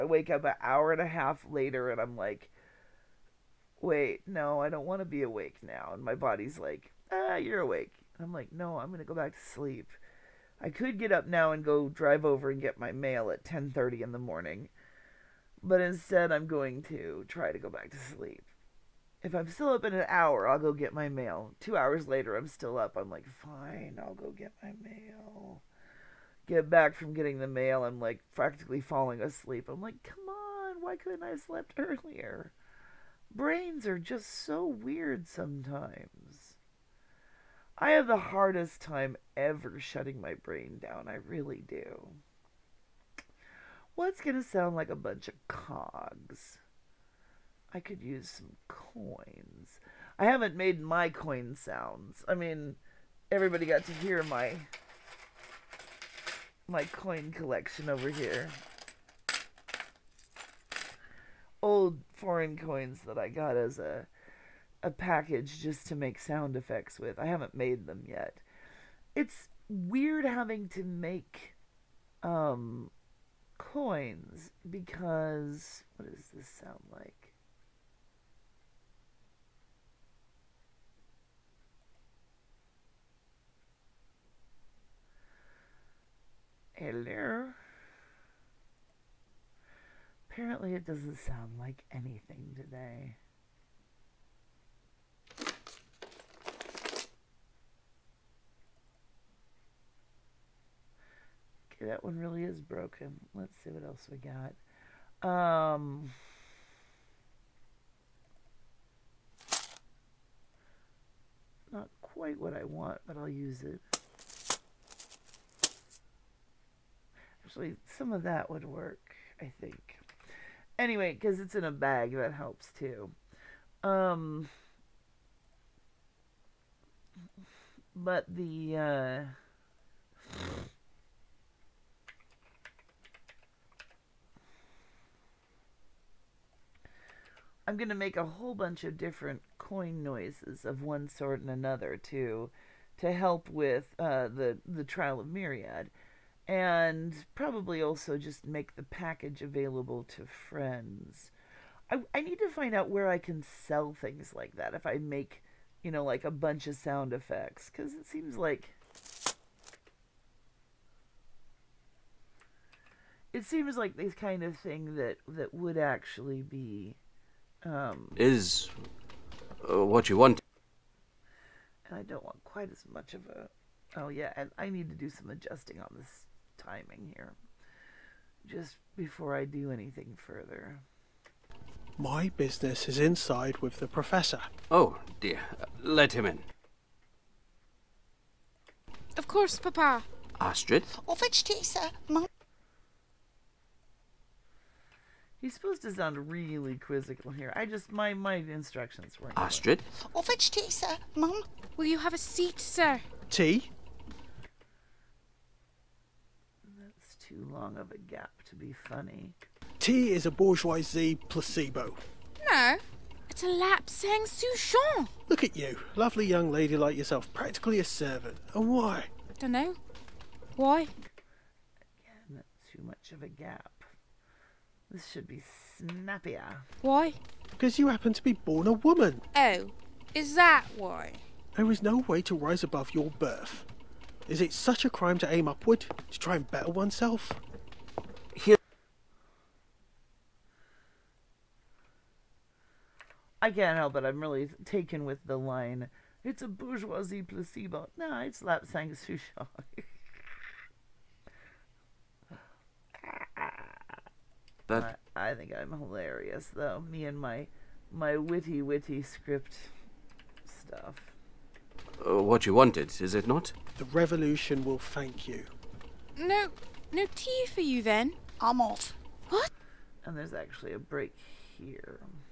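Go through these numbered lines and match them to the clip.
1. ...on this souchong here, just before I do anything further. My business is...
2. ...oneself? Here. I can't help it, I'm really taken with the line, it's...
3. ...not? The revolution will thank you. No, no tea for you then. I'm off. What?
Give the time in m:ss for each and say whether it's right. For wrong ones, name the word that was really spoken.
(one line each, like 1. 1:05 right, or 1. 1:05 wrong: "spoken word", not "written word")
1. 2:55 wrong: "timing", not "souchong"
2. 3:56 right
3. 4:23 right.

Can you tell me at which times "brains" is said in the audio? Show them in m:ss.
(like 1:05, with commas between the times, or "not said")
0:33, 0:40.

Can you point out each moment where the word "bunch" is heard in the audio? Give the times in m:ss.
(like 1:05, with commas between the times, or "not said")
0:44, 2:18, 2:36.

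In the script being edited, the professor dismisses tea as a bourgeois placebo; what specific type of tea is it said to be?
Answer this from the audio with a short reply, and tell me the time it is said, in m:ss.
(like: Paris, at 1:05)
lapsang souchong, at 3:33.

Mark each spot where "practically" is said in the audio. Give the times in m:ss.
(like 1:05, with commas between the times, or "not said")
0:28, 3:37.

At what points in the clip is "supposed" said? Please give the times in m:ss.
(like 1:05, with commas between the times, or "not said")
3:15.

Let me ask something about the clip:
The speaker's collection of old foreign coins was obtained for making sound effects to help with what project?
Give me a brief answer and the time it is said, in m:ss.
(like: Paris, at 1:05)
the trial of myriad, at 2:24.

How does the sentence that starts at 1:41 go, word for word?
Okay, that one really is broken.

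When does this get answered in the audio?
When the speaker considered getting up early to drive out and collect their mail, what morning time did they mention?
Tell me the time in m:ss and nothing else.
0:13.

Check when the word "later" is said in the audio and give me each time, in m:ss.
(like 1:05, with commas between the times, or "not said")
0:01, 0:22.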